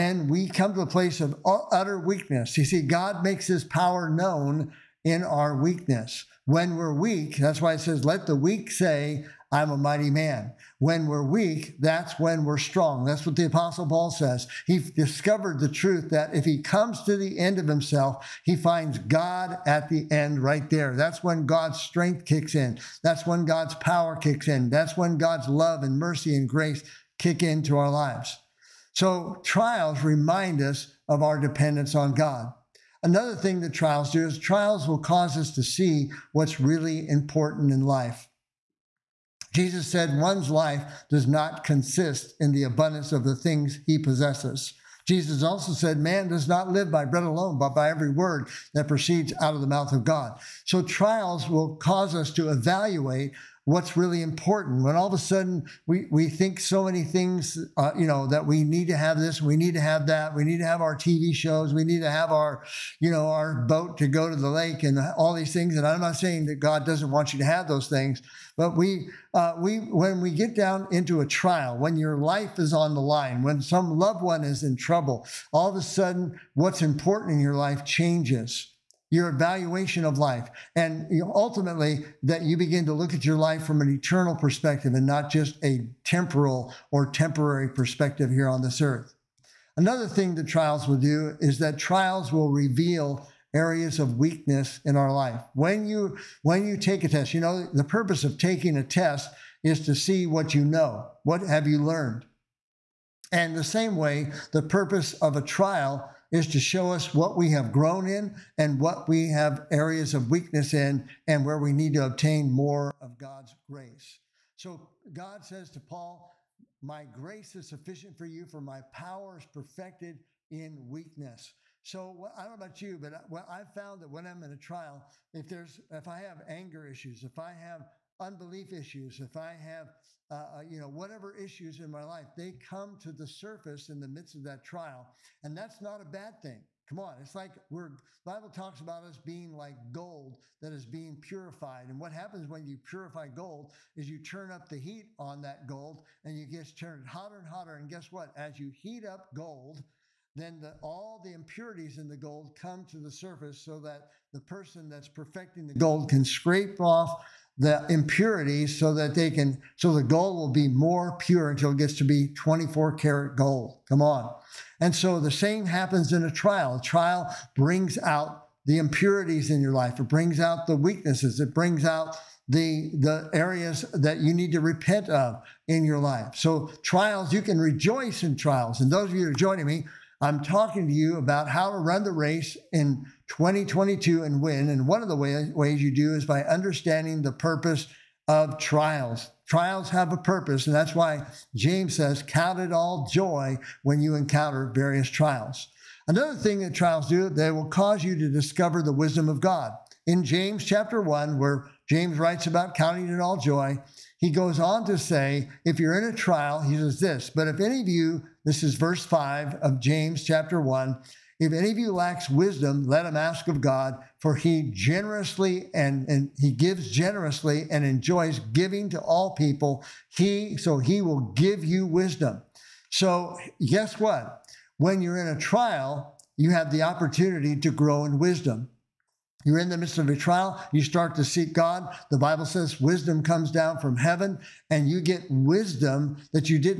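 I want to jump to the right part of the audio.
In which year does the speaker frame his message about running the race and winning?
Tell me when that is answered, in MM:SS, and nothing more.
03:03.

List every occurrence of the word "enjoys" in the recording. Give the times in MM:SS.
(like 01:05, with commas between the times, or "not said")
03:37.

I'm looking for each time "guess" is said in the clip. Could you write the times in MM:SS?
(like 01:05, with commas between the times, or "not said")
02:27, 03:43.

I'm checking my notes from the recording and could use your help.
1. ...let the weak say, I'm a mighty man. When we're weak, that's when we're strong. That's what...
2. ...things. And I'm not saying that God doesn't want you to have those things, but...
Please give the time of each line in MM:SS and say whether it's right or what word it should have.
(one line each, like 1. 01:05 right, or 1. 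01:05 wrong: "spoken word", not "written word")
1. 00:08 right
2. 01:05 right.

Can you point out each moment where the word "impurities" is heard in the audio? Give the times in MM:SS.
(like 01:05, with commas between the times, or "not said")
02:31, 02:37, 02:48.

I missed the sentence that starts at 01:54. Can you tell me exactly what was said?
So God says to Paul, My grace is sufficient for you, for my power is perfected in weakness.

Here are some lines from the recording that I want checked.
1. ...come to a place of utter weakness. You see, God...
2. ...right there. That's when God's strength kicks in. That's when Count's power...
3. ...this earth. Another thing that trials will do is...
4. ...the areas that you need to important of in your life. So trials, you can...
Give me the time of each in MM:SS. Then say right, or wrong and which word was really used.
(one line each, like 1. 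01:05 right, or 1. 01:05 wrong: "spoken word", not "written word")
1. 00:00 right
2. 00:20 wrong: "God", not "Count"
3. 01:28 right
4. 02:52 wrong: "repent", not "important".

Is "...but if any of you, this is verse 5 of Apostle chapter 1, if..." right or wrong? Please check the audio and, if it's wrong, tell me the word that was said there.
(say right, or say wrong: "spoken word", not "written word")
wrong: "James", not "Apostle".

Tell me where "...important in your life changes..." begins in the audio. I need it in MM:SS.
01:16.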